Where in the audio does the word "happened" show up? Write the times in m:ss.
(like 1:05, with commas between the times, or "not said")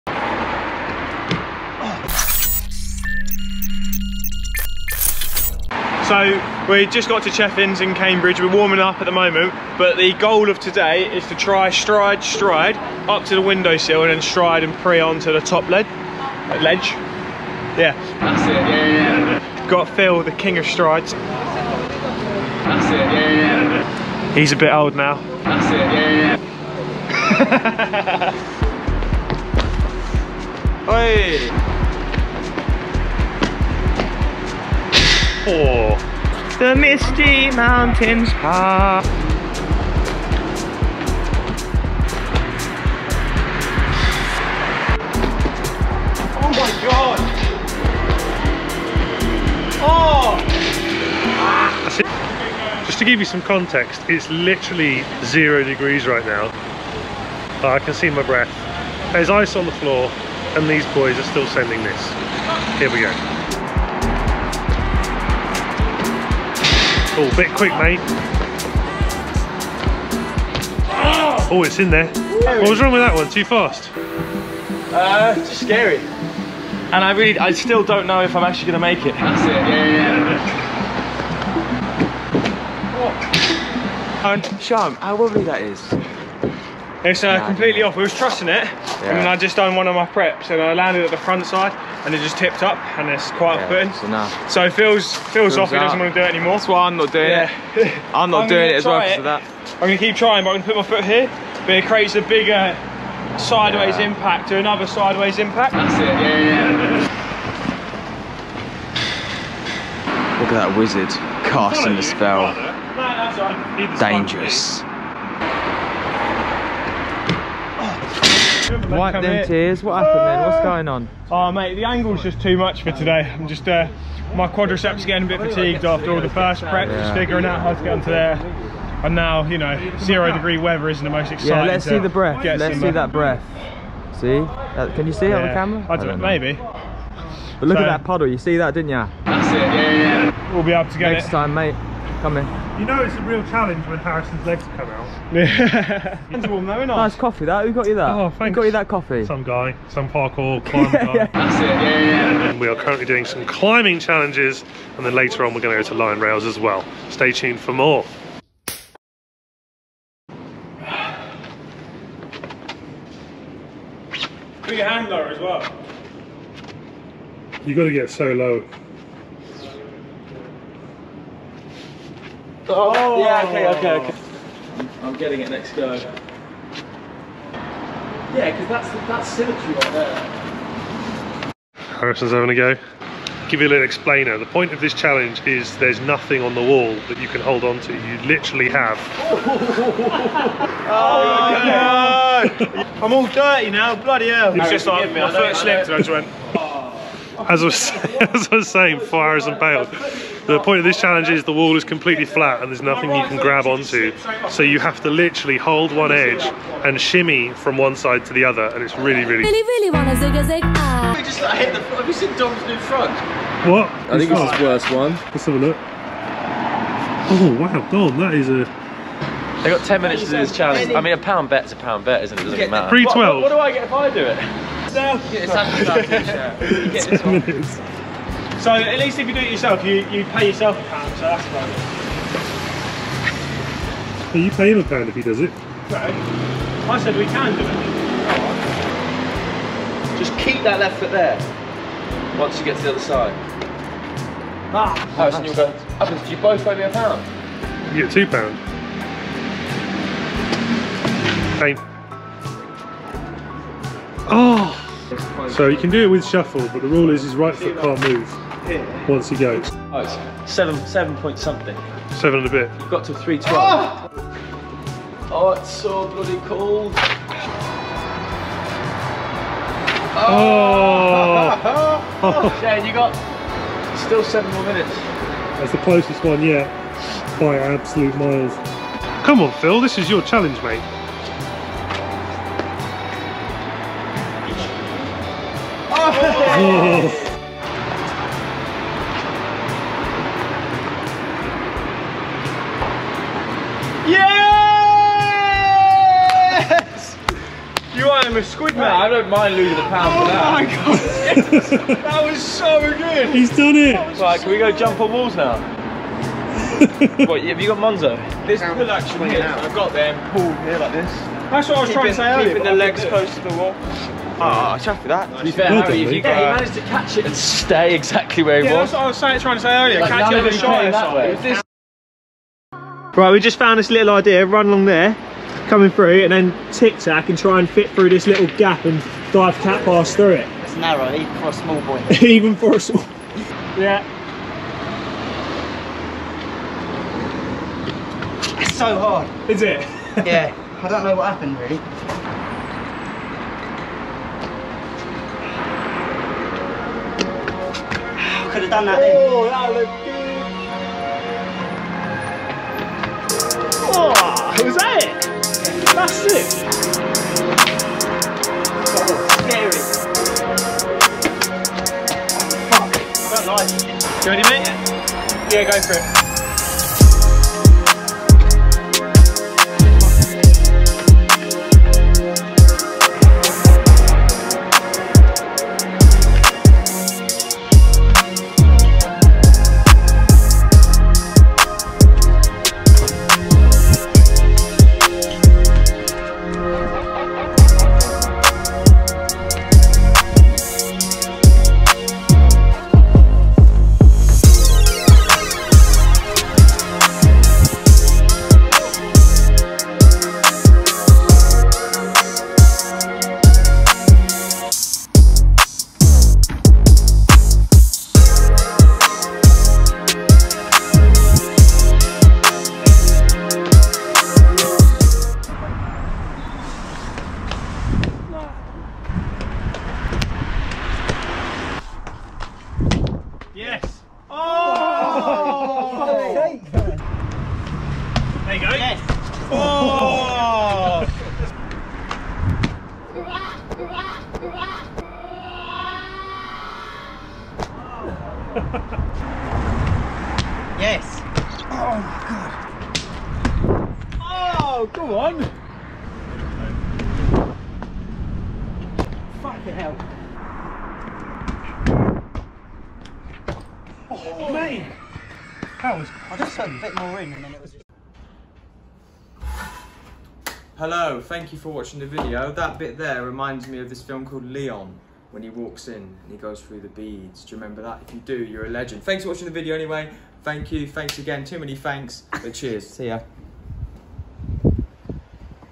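2:00, 5:41.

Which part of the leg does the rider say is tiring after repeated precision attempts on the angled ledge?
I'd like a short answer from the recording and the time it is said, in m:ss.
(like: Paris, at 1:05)
Quadriceps, at 2:04.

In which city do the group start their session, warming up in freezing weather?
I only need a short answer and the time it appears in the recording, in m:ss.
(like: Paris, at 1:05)
Cambridge, at 0:07.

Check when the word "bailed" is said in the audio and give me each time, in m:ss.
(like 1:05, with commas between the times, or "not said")
3:19.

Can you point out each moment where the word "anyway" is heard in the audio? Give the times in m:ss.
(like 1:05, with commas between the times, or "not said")
7:49.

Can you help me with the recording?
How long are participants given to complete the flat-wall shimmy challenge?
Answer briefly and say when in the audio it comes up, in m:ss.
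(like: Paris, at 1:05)
10 minutes, at 3:39.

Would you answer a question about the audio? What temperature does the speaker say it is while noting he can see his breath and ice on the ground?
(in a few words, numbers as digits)
0 degrees.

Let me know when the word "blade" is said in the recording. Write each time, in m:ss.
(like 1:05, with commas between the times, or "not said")
not said.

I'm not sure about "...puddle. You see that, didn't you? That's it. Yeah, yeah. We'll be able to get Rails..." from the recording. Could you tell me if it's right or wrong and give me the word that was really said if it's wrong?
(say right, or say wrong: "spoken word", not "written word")
wrong: "Next", not "Rails".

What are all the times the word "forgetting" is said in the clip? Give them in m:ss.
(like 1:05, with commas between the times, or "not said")
not said.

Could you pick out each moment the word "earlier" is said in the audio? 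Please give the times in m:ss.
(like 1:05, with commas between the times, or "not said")
5:12, 5:19.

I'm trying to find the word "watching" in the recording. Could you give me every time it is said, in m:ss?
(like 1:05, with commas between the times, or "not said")
7:41, 7:49.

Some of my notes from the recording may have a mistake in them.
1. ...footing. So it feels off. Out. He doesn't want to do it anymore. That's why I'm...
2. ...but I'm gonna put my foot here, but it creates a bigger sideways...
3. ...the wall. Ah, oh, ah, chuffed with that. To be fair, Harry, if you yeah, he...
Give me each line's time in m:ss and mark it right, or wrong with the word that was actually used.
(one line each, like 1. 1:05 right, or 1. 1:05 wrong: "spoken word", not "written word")
1. 1:33 right
2. 1:40 right
3. 5:13 right.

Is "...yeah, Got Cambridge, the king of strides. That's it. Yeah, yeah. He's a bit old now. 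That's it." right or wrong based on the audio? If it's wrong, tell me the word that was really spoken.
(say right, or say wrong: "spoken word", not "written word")
wrong: "Phil", not "Cambridge".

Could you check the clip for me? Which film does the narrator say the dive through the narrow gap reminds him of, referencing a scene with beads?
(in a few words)
Leon.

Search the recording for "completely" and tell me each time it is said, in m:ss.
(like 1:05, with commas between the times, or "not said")
1:27, 3:21.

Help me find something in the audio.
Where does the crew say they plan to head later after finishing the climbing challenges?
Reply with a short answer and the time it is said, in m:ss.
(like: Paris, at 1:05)
Lion Rails, at 2:35.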